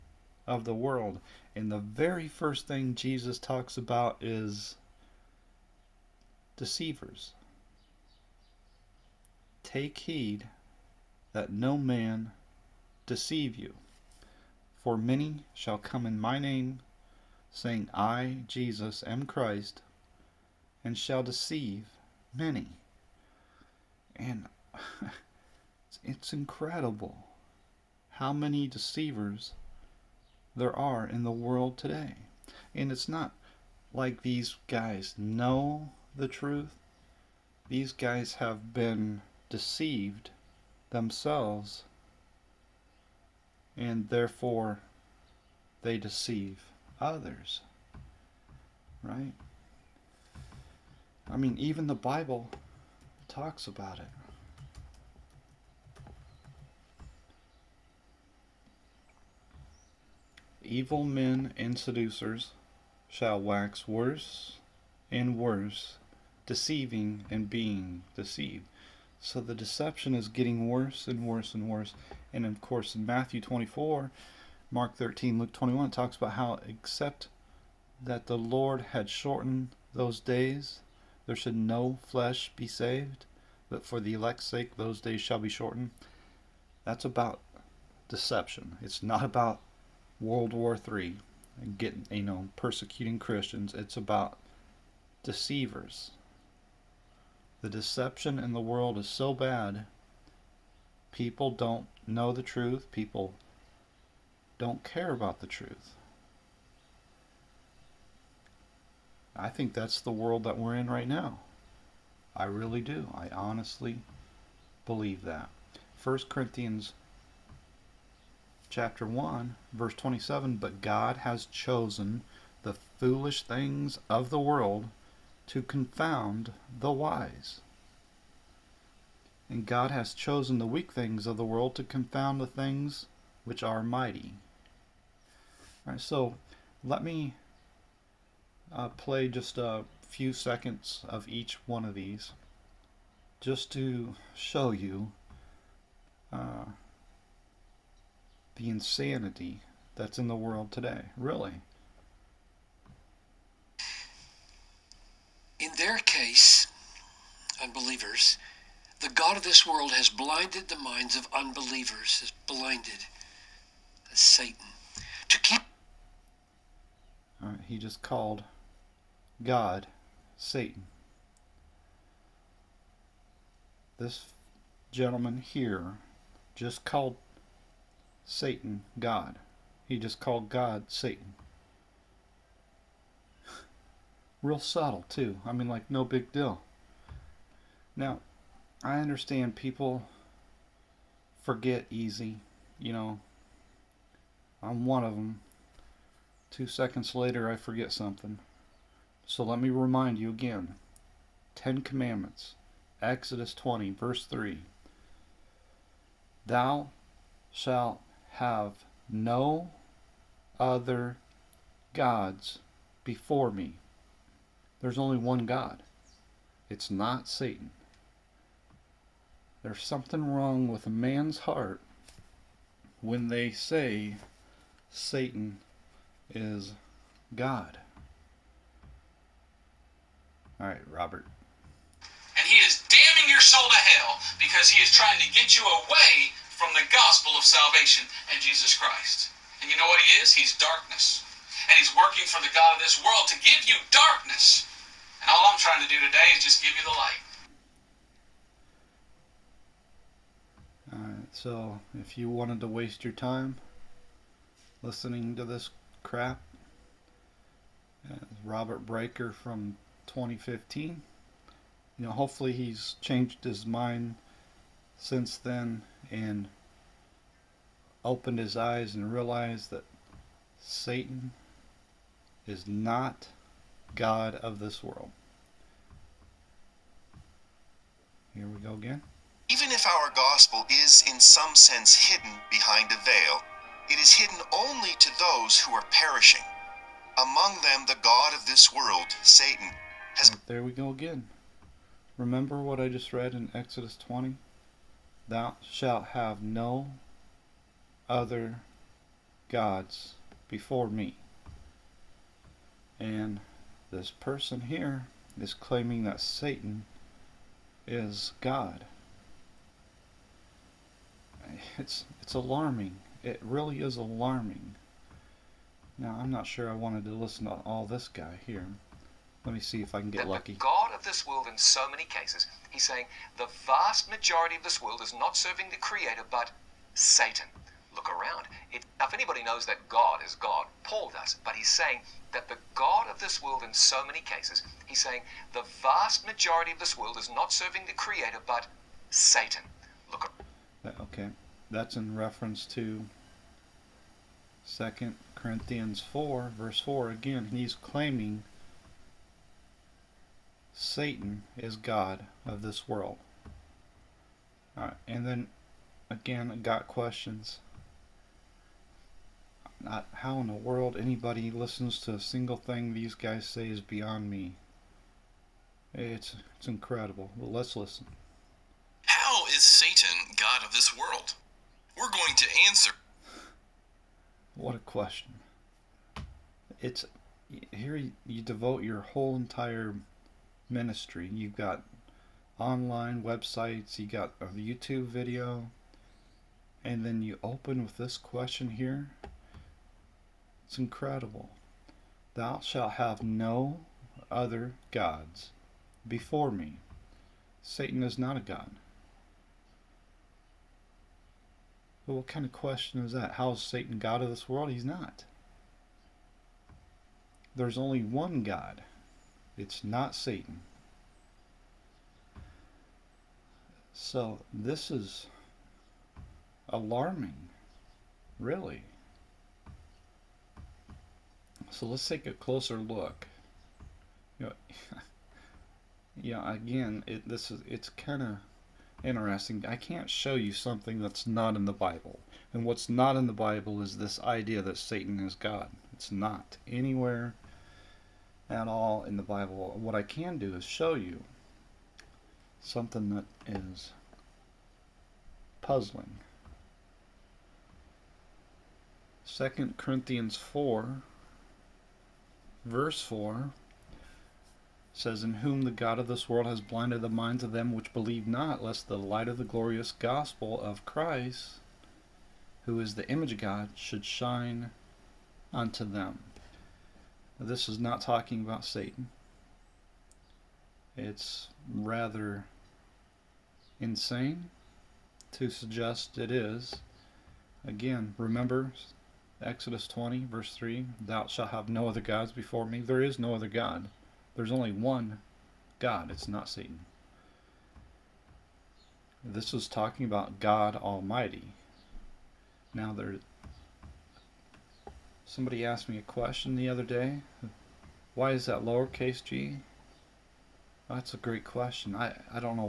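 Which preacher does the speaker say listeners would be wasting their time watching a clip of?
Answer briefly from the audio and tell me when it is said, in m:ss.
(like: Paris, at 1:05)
Robert Breaker, at 4:18.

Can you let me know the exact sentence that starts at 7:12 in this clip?
And what's not in the Bible is this idea that Satan is God.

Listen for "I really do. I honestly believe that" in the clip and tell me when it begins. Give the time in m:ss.
1:52.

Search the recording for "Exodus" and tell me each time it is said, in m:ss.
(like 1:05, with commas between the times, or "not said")
3:23, 4:53, 7:59.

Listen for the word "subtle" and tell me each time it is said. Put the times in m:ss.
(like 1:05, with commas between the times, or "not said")
3:04.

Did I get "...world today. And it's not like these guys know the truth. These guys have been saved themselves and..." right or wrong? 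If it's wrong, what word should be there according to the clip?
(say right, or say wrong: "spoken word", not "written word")
wrong: "deceived", not "saved".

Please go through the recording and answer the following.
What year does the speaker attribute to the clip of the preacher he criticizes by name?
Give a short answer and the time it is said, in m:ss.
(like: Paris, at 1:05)
2015, at 4:20.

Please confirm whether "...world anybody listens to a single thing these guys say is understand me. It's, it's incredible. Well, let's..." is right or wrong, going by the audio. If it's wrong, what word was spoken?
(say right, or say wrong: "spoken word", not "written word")
wrong: "beyond", not "understand".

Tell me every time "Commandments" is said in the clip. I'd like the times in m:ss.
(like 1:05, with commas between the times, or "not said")
3:21.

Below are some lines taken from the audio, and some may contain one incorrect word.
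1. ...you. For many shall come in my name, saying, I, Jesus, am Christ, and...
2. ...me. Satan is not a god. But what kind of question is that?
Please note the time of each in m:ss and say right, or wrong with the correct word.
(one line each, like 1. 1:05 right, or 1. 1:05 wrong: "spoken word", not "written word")
1. 0:13 right
2. 6:36 right.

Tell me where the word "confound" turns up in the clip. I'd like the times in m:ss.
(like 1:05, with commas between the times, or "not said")
2:05, 2:11.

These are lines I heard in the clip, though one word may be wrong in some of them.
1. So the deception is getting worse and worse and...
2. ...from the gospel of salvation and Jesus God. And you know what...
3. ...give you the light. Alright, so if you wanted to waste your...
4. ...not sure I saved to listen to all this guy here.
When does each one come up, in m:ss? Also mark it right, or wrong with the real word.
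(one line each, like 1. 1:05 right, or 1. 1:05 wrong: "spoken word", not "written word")
1. 1:09 right
2. 3:56 wrong: "Christ", not "God"
3. 4:06 right
4. 5:16 wrong: "wanted", not "saved".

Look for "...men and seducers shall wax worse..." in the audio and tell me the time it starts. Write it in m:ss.
1:01.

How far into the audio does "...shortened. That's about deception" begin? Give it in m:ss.
1:25.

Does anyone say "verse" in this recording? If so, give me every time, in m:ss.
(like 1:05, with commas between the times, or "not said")
1:59, 3:23, 5:46, 7:32, 8:00.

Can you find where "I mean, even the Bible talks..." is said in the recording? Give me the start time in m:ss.
0:51.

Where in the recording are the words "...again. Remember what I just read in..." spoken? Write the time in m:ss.
4:50.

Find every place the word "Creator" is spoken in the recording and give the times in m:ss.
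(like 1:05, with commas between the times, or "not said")
5:25, 5:37.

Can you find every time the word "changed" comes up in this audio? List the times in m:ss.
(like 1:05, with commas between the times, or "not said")
4:23.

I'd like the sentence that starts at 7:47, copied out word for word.
This is not talking about Satan.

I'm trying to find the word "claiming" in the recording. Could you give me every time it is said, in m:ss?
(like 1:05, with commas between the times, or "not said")
5:05, 5:47.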